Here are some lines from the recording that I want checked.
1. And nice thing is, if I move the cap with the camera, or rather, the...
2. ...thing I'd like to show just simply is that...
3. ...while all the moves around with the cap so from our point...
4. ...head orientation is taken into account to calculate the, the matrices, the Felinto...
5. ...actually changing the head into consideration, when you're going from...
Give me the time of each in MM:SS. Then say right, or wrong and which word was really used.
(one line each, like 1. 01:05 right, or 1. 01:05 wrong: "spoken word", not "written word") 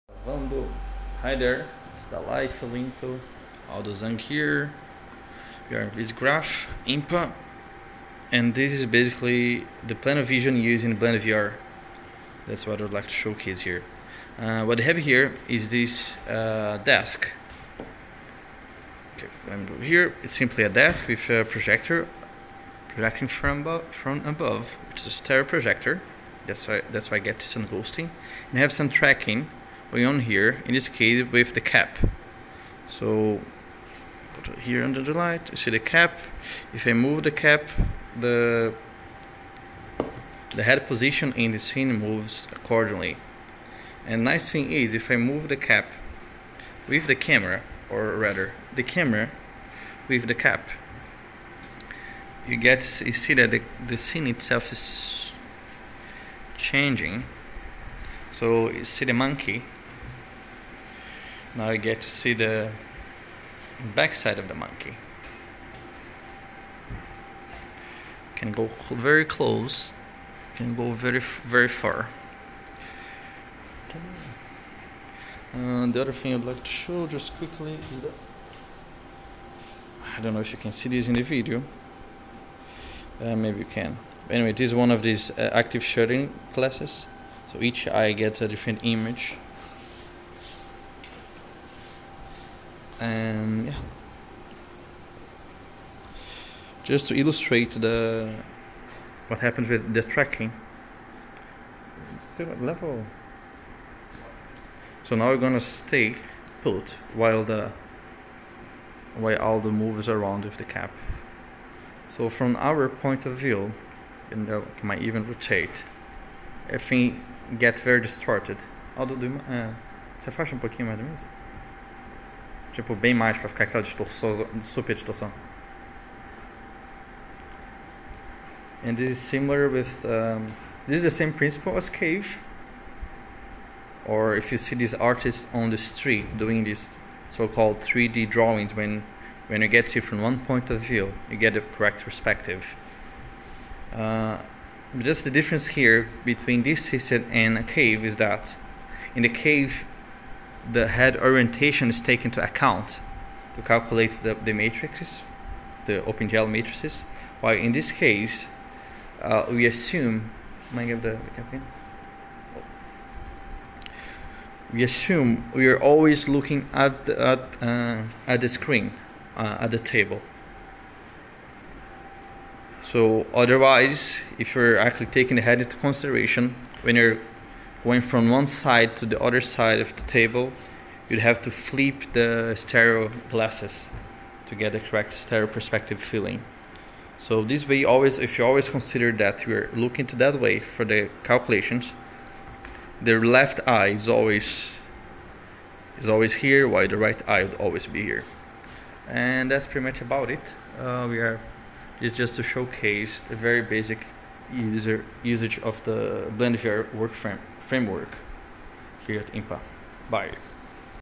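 1. 00:44 right
2. 01:16 wrong: "quickly", not "simply"
3. 01:49 right
4. 02:30 wrong: "OpenGL", not "Felinto"
5. 02:54 wrong: "taking", not "changing".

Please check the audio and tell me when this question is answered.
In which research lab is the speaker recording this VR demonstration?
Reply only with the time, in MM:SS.
00:05.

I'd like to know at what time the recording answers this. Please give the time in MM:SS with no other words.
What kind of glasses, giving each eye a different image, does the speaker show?
01:25.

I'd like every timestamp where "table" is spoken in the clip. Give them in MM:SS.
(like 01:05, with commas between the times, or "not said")
02:49, 03:00.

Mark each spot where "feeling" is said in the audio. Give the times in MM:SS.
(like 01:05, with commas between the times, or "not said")
03:05.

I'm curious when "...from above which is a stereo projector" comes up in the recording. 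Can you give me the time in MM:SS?
00:23.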